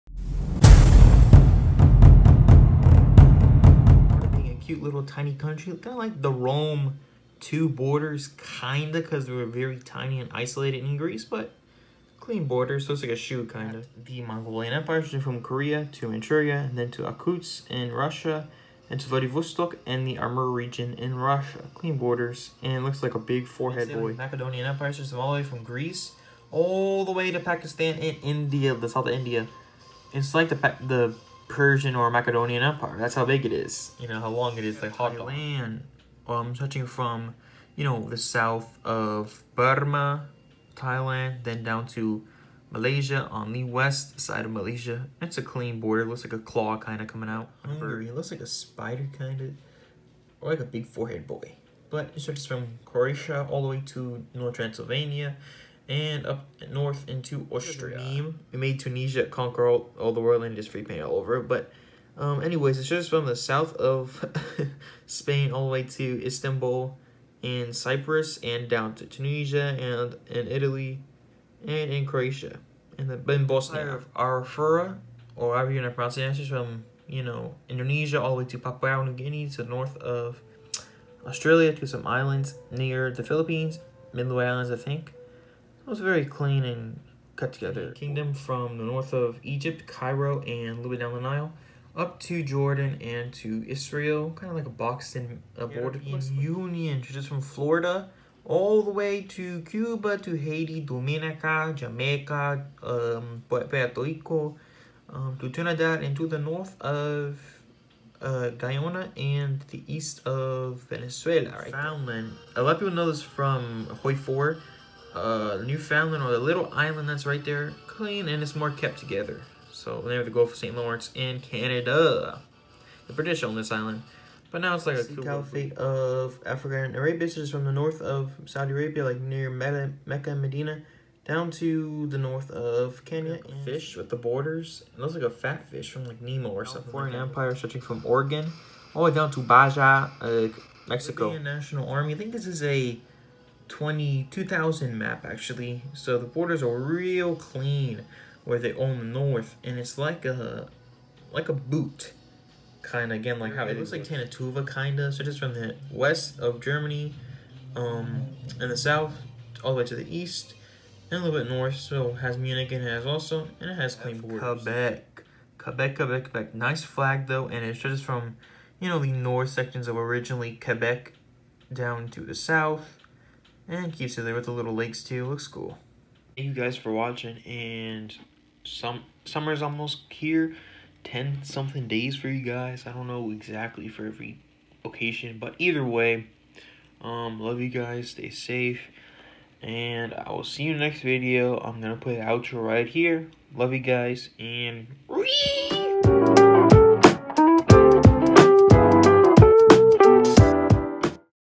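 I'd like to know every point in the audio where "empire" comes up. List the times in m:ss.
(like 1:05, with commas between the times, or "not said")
0:14, 0:24, 0:32, 2:17.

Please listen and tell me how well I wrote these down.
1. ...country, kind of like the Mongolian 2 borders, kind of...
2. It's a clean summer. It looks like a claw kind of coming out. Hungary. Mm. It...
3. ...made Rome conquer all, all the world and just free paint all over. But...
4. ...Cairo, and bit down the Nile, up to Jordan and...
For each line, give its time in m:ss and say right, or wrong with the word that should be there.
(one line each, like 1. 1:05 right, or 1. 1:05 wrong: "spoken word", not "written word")
1. 0:05 wrong: "Rome", not "Mongolian"
2. 0:45 wrong: "border", not "summer"
3. 0:58 wrong: "Tunisia", not "Rome"
4. 1:29 right.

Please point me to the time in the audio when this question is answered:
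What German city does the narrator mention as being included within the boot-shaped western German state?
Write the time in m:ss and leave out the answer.
2:42.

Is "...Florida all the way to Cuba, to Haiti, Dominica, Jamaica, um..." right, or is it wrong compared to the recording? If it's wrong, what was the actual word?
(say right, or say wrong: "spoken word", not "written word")
right.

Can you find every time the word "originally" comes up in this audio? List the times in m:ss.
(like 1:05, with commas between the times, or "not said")
2:49.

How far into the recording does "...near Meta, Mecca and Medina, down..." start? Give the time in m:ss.
2:09.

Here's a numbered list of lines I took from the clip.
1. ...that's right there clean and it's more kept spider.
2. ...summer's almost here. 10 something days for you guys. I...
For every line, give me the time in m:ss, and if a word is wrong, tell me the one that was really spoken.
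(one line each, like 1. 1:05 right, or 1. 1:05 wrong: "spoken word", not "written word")
1. 1:57 wrong: "together", not "spider"
2. 2:59 right.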